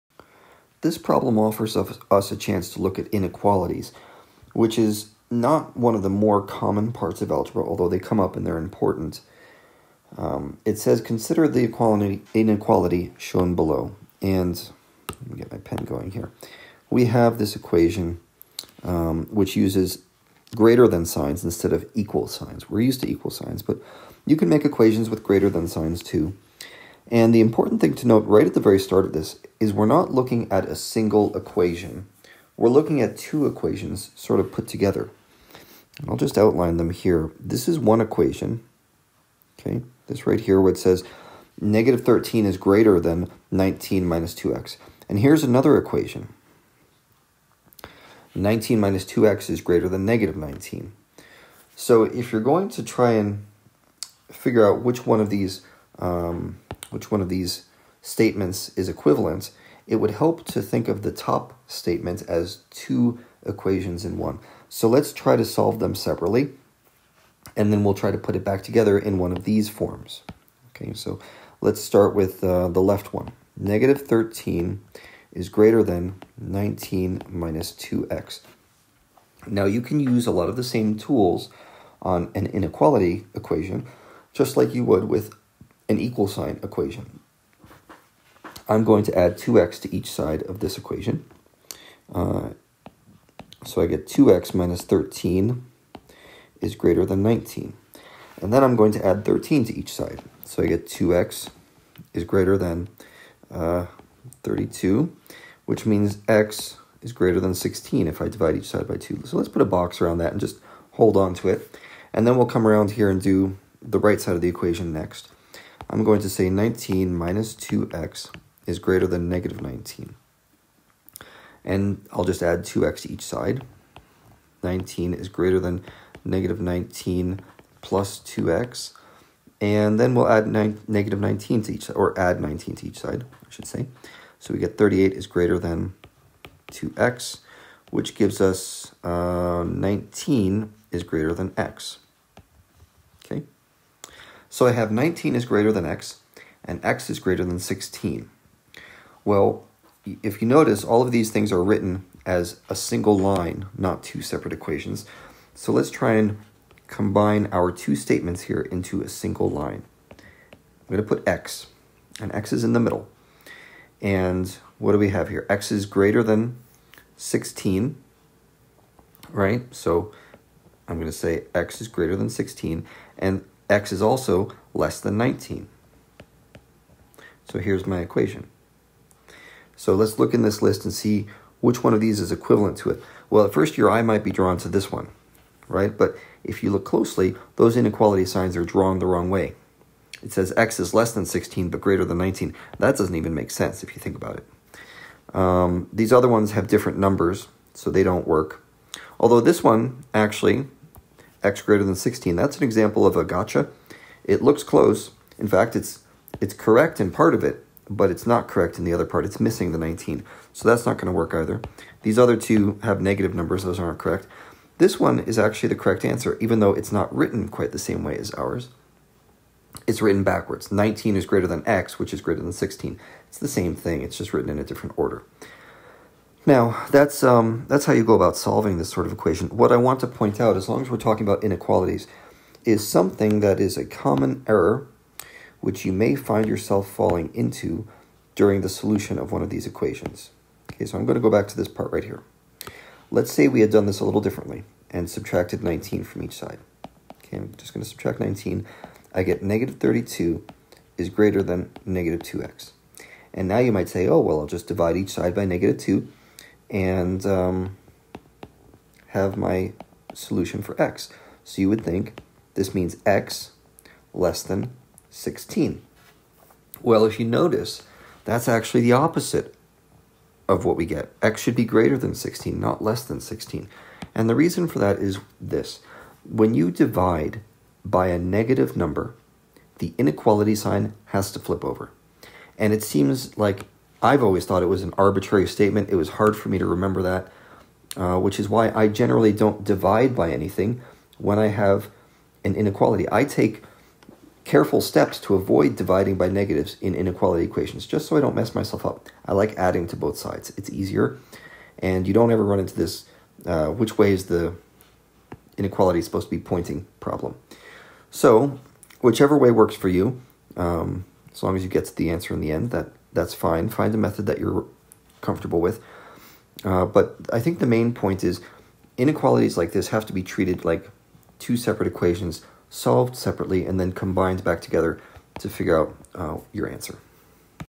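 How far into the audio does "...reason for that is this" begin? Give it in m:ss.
4:34.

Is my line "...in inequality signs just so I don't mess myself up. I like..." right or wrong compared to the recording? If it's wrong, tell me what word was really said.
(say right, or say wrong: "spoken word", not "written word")
wrong: "equations", not "signs".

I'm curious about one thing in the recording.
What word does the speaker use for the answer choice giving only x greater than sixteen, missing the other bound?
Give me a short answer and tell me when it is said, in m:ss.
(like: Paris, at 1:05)
gotcha, at 3:23.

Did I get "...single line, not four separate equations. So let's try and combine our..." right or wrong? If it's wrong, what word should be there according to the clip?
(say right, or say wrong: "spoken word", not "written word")
wrong: "two", not "four".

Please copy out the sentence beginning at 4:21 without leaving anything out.
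So you would think this means x less than 16.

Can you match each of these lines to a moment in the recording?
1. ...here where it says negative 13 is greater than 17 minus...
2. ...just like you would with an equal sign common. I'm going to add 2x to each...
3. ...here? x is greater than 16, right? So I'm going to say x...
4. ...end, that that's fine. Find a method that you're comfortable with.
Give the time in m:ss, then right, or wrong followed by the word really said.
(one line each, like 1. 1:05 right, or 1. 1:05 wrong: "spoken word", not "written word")
1. 0:40 wrong: "19", not "17"
2. 1:24 wrong: "equation", not "common"
3. 2:45 right
4. 5:12 right.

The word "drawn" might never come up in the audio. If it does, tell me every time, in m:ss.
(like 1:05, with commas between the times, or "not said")
3:04, 3:08.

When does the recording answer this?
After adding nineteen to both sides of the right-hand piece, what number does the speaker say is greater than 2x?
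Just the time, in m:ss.
2:14.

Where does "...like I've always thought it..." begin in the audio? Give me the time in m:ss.
4:43.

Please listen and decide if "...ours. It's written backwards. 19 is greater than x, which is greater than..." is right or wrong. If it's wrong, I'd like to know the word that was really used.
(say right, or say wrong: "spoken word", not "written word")
right.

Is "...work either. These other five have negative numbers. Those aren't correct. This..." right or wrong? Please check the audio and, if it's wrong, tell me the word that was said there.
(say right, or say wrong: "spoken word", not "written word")
wrong: "two", not "five".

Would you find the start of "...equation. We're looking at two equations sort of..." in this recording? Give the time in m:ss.
0:31.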